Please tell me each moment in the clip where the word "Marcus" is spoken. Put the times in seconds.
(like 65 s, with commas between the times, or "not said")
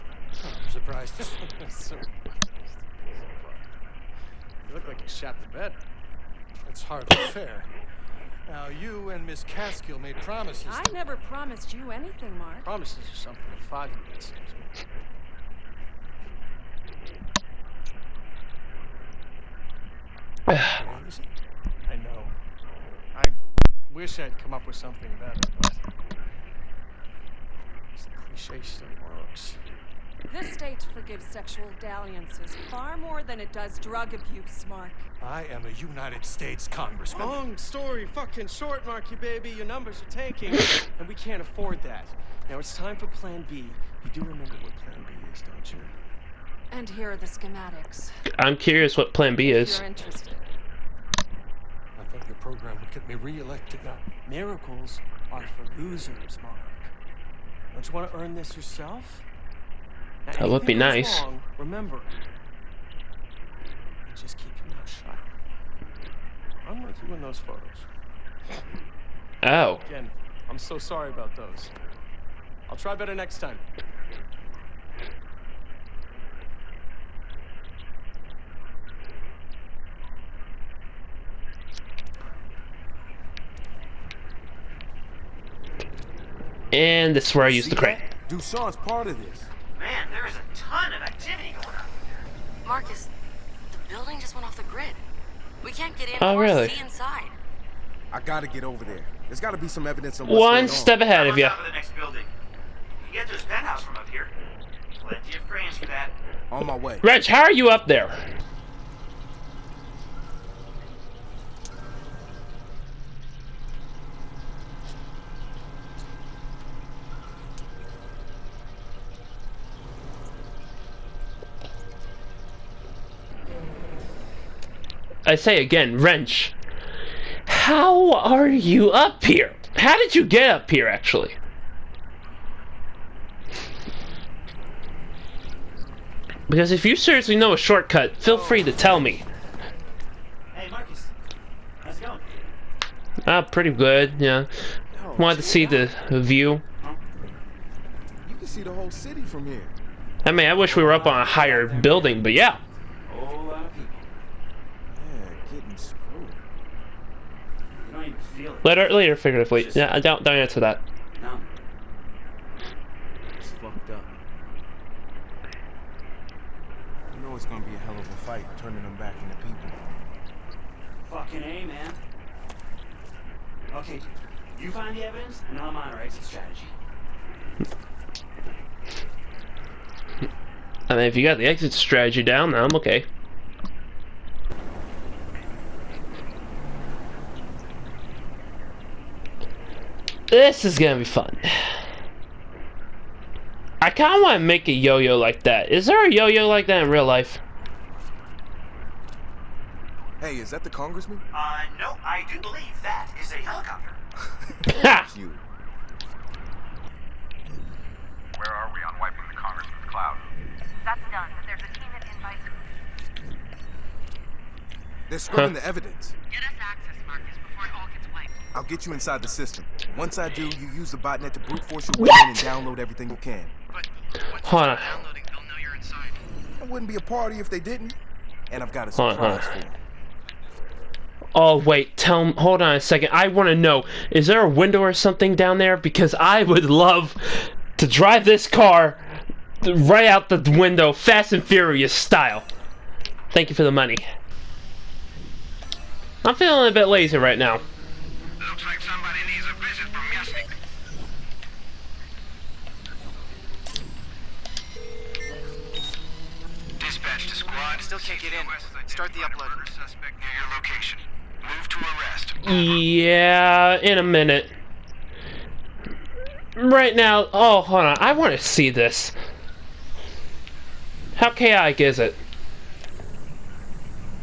92 s, 140 s, 217 s.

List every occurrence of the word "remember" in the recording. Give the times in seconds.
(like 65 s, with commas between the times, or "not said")
44 s, 61 s.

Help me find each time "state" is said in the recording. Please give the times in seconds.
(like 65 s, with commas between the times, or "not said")
30 s, 36 s.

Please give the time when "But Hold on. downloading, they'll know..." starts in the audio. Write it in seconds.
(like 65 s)
223 s.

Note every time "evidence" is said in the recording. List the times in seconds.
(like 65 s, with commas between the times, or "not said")
99 s, 175 s, 215 s.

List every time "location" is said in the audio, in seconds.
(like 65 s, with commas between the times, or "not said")
260 s.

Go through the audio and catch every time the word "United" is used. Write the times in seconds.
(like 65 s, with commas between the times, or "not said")
35 s.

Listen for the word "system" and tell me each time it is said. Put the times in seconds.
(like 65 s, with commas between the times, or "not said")
219 s.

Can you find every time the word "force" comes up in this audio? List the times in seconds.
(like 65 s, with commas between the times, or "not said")
221 s.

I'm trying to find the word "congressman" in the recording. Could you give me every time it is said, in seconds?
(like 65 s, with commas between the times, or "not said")
36 s, 200 s, 209 s.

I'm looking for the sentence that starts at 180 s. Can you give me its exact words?
I mean, if you got the exit strategy down, then I'm okay.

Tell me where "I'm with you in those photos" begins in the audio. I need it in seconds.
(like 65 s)
66 s.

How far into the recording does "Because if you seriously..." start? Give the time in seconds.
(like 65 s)
136 s.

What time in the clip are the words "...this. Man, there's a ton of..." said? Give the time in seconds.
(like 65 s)
89 s.